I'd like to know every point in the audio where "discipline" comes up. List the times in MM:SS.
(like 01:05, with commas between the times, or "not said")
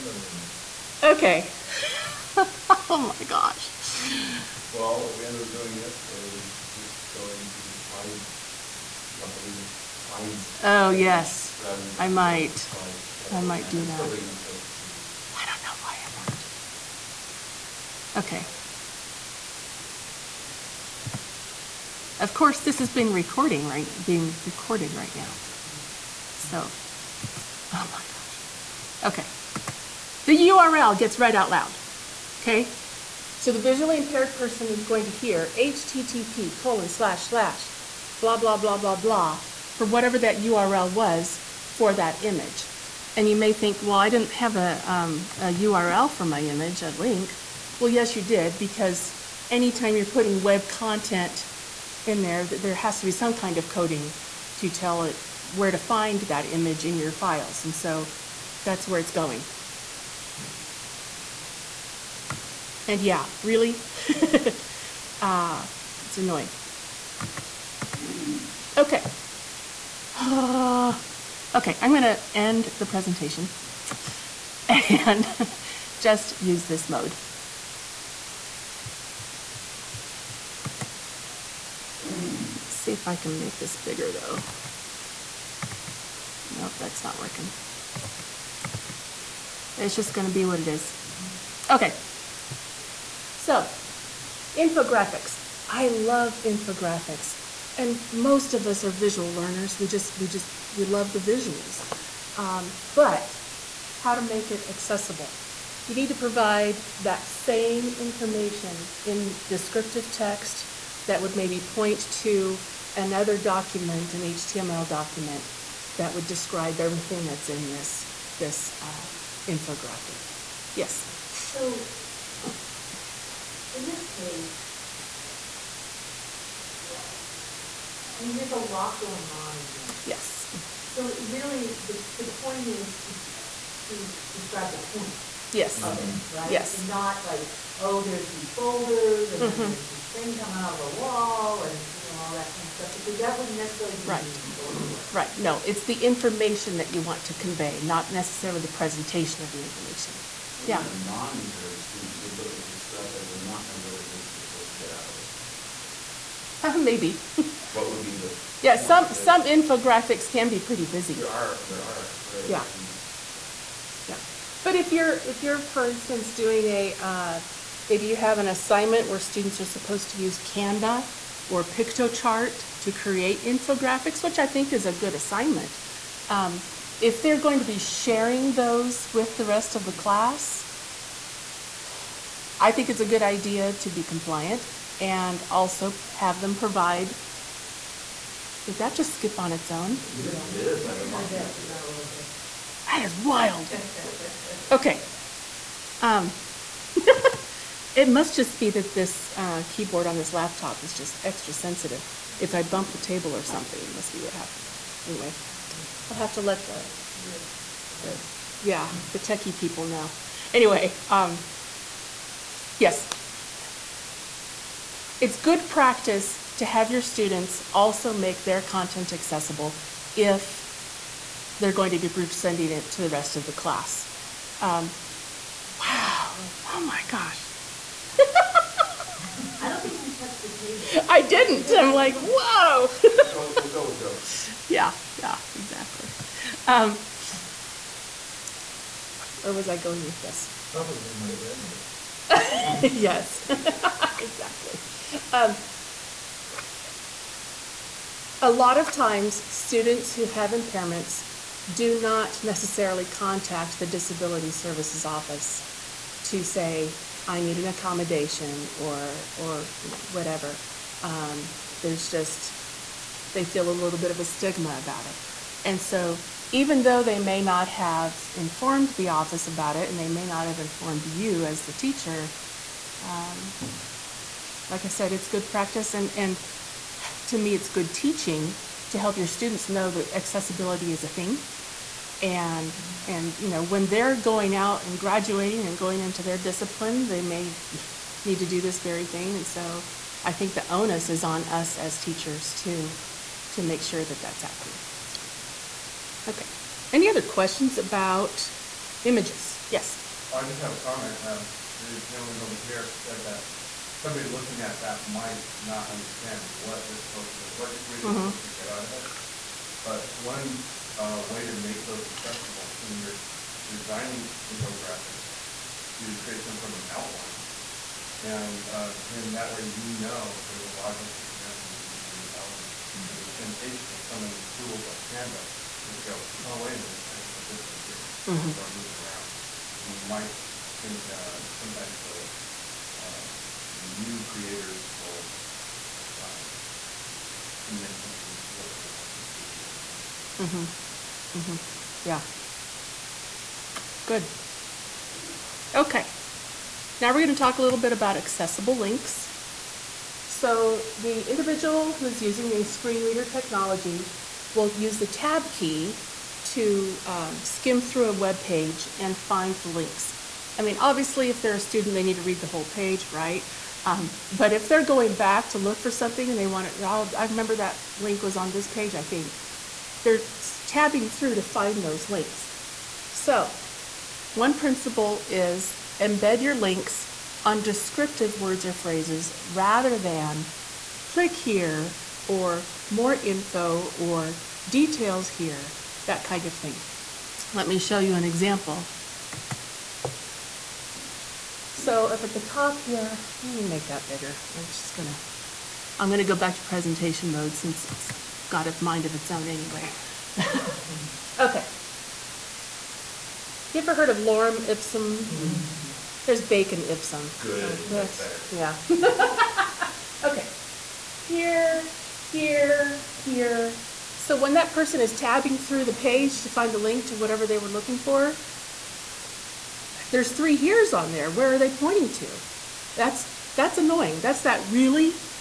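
04:46.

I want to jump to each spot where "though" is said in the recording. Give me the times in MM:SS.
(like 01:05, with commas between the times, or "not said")
01:24, 04:26.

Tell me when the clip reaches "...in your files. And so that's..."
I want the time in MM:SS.
00:56.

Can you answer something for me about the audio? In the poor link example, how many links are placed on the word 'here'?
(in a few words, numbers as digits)
3.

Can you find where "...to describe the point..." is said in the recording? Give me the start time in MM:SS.
02:13.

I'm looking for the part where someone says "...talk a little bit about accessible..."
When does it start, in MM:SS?
05:47.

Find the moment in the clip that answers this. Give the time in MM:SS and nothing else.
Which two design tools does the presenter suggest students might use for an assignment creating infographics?
02:50.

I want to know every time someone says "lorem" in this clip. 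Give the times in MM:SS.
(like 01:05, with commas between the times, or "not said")
06:44.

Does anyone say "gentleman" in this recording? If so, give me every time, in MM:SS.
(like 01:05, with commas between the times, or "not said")
05:02.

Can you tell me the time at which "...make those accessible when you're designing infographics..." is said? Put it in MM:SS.
05:11.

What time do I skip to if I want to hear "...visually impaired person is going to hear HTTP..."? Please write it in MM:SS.
00:33.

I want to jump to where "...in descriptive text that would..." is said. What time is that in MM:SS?
01:49.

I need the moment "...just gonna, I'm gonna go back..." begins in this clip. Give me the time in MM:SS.
06:34.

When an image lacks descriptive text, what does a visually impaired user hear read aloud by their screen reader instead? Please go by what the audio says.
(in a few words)
The URL.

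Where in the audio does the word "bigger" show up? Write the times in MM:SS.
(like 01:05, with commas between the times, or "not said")
01:23, 06:34.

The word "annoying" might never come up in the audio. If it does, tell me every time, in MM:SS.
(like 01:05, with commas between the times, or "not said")
01:06, 07:03.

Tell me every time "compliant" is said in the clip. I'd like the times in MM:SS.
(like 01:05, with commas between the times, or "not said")
03:04.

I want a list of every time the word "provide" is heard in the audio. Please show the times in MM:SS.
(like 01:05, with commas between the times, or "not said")
01:46, 03:06.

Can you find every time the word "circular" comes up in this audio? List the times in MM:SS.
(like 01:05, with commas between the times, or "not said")
not said.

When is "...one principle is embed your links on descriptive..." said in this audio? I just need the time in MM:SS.
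06:14.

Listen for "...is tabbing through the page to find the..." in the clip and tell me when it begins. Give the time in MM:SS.
06:54.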